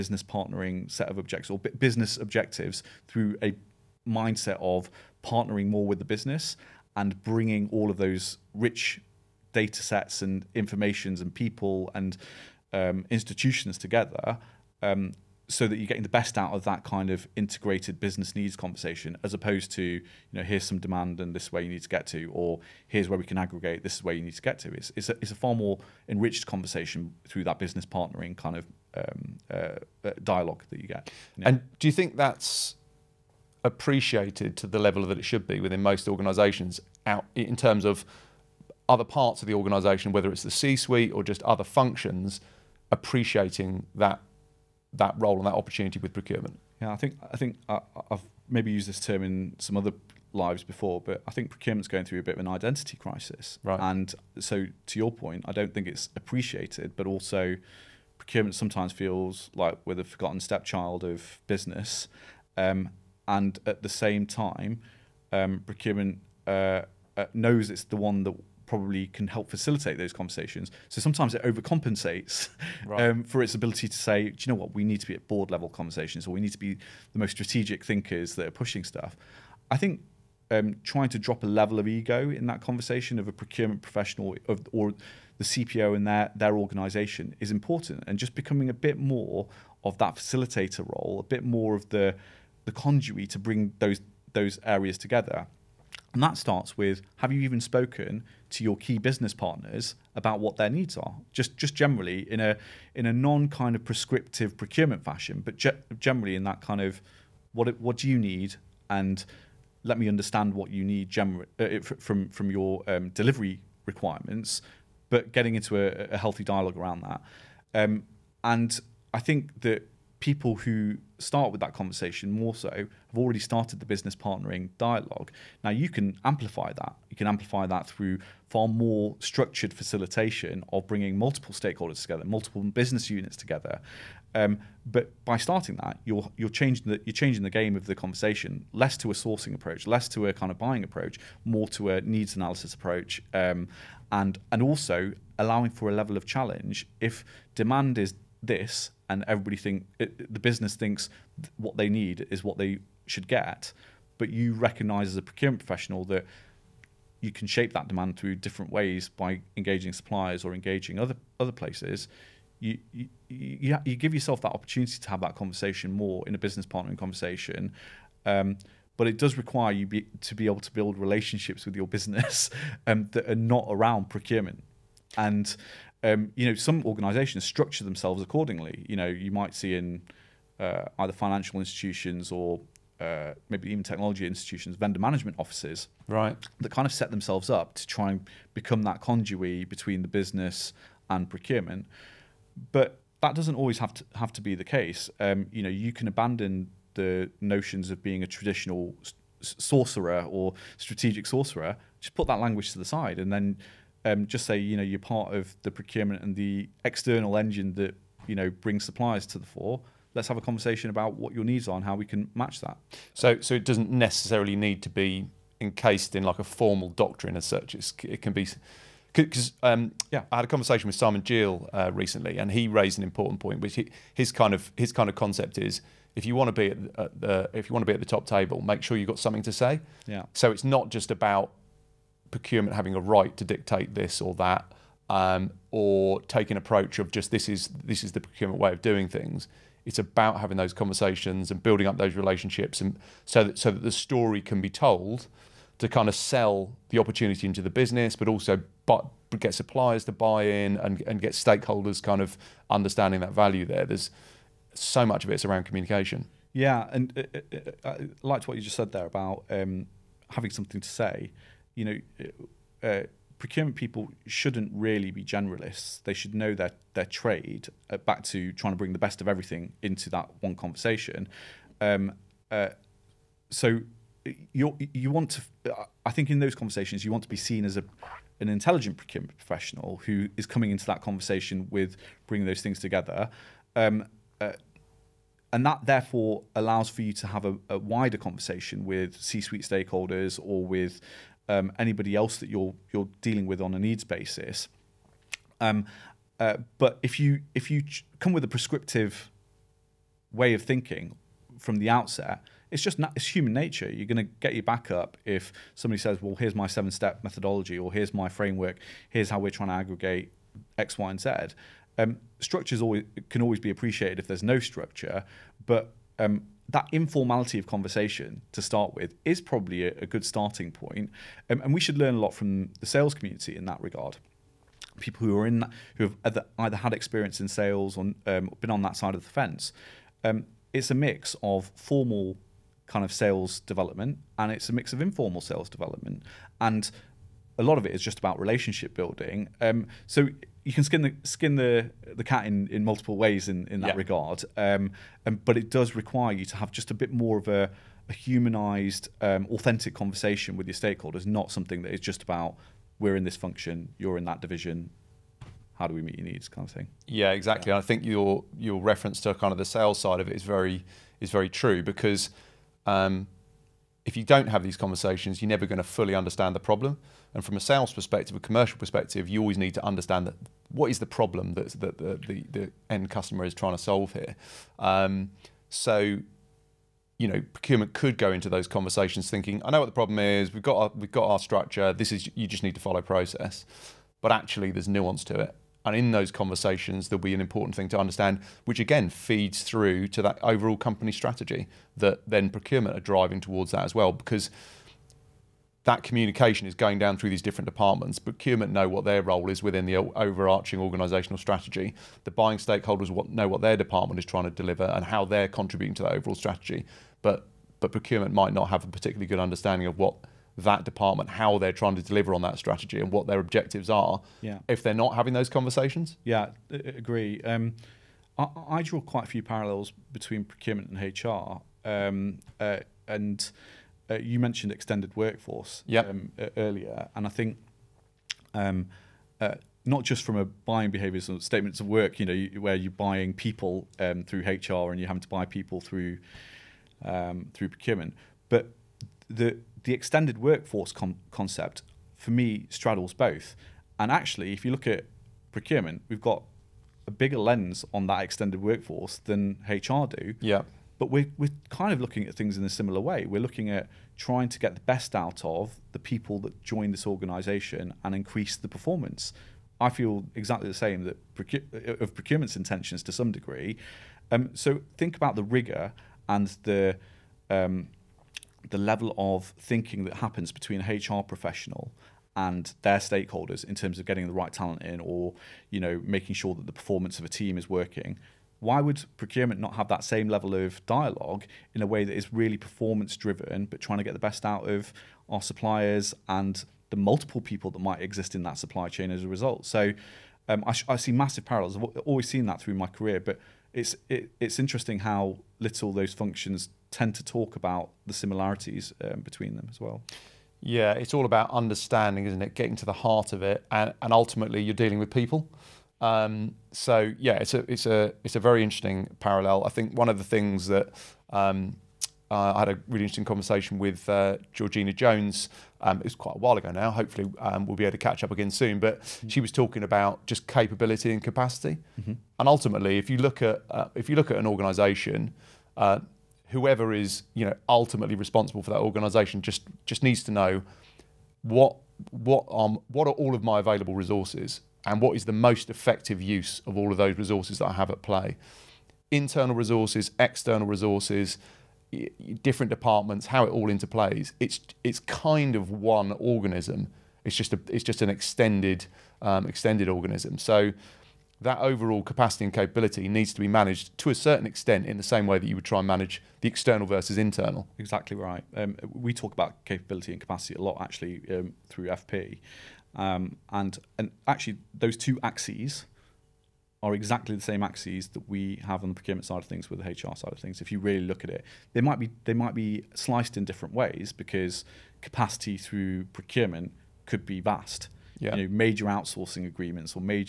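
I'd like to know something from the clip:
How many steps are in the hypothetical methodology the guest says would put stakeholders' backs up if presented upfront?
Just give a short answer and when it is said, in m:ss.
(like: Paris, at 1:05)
7, at 5:06.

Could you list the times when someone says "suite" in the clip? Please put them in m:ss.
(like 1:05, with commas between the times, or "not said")
0:40, 4:49.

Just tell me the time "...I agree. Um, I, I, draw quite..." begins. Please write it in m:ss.
6:56.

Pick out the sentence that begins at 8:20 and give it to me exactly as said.
Yeah, it's all about understanding, isn't it?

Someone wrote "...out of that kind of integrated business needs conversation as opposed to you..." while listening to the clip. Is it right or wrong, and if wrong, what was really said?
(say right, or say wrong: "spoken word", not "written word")
right.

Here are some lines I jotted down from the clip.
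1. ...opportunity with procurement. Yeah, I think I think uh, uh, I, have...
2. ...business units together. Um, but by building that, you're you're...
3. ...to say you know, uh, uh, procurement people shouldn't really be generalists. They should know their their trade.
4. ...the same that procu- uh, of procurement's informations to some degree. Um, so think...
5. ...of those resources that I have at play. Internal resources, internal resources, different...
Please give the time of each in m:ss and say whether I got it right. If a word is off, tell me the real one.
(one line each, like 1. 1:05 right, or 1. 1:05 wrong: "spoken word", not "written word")
1. 0:45 right
2. 2:12 wrong: "starting", not "building"
3. 4:20 right
4. 7:40 wrong: "intentions", not "informations"
5. 8:56 wrong: "external", not "internal".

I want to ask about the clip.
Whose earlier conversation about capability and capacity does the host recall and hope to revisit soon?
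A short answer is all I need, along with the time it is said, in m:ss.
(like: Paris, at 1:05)
Georgina Jones, at 8:34.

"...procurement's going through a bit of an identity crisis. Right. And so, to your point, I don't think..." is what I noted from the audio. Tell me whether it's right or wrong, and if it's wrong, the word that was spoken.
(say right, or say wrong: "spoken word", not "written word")
right.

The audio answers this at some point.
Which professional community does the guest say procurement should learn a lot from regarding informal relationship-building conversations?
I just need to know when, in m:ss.
5:22.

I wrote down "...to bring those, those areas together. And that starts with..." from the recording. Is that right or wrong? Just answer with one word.
right.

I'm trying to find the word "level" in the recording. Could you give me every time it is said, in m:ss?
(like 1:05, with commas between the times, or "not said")
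0:34, 1:15, 1:21, 2:25, 7:48, 8:00.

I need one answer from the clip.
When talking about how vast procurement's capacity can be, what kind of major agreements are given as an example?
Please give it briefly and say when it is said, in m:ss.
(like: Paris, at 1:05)
outsourcing agreements, at 9:38.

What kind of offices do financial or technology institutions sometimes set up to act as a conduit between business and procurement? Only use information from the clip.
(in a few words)
vendor management offices.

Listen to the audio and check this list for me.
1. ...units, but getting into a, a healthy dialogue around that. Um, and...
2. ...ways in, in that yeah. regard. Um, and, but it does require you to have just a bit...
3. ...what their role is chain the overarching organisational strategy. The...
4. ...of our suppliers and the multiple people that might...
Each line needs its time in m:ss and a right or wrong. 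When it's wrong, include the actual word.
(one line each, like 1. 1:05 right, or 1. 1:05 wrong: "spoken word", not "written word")
1. 1:53 wrong: "requirements", not "units"
2. 5:43 right
3. 6:38 wrong: "within", not "chain"
4. 8:04 right.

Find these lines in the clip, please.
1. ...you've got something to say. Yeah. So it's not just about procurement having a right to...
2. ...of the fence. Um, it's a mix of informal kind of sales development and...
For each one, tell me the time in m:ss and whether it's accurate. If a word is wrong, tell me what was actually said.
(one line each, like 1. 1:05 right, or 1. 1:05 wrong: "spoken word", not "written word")
1. 3:48 right
2. 5:29 wrong: "formal", not "informal".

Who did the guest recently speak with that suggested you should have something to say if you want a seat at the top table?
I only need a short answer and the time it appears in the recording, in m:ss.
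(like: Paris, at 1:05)
Simon Gill, at 3:40.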